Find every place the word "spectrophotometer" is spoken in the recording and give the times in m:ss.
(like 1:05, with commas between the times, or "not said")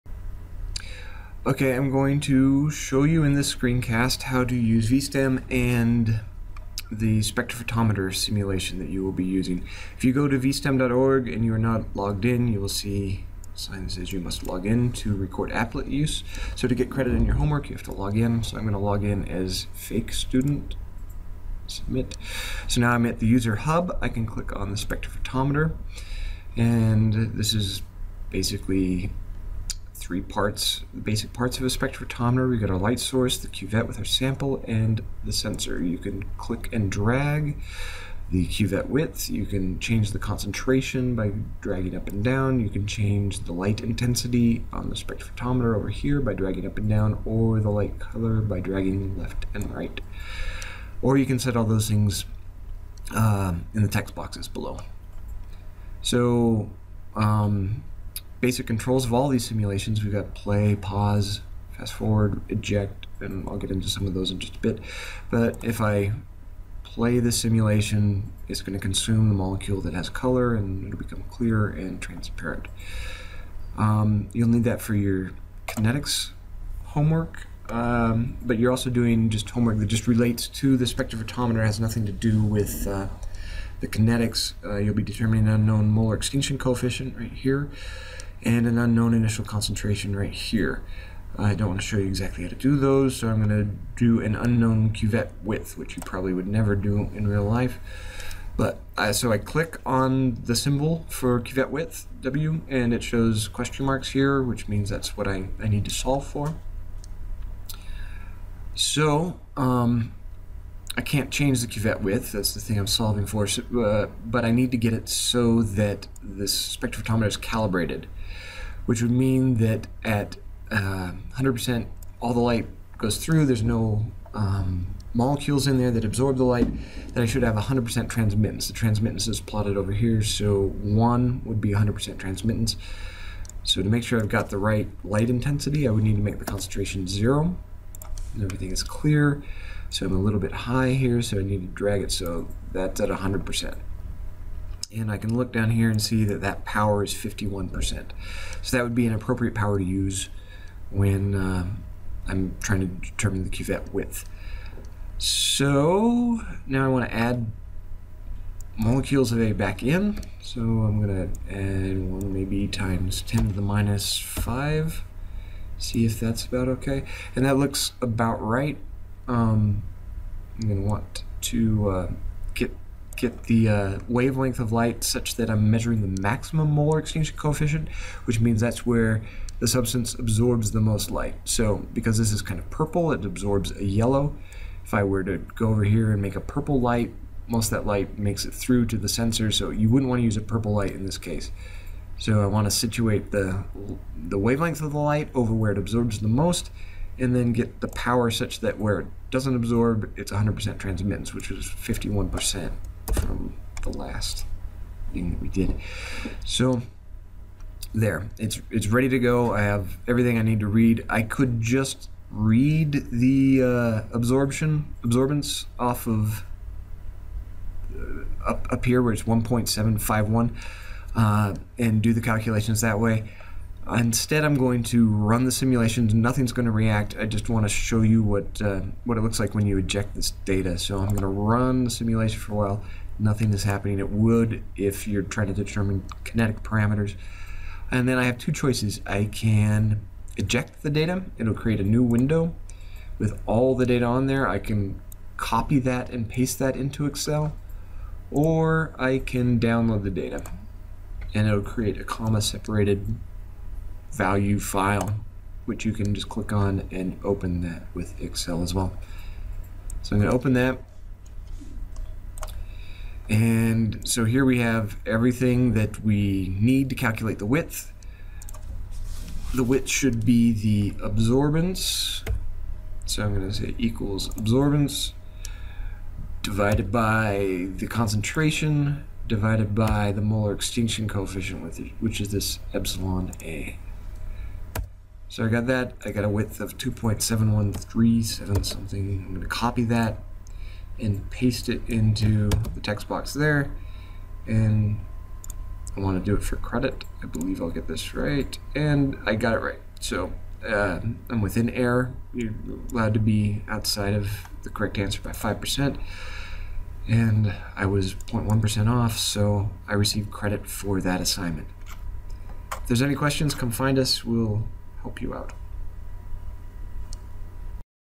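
0:07, 0:24, 0:31, 0:44, 1:20, 1:56.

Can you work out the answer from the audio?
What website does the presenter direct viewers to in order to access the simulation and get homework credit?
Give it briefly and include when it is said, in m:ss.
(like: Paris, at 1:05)
vstem.org, at 0:10.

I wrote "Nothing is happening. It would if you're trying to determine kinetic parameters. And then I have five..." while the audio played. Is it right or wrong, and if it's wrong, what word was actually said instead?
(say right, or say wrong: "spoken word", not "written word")
wrong: "two", not "five".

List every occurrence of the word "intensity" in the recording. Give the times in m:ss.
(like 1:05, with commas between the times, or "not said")
0:43, 2:15.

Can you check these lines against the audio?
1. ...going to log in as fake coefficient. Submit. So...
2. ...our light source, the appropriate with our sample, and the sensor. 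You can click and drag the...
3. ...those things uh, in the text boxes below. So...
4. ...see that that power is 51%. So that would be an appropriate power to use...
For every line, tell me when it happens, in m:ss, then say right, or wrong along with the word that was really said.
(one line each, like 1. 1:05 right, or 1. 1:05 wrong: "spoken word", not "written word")
1. 0:18 wrong: "student", not "coefficient"
2. 0:32 wrong: "cuvette", not "appropriate"
3. 0:51 right
4. 2:26 right.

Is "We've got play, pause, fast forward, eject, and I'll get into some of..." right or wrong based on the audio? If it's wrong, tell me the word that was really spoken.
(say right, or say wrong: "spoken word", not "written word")
right.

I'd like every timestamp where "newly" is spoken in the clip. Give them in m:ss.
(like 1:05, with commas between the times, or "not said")
not said.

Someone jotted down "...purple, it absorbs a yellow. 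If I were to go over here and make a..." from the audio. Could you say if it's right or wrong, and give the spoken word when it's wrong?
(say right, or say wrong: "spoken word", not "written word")
right.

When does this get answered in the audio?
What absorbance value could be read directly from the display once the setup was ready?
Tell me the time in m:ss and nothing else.
3:39.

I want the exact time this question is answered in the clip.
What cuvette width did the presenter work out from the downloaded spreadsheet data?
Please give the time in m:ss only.
4:46.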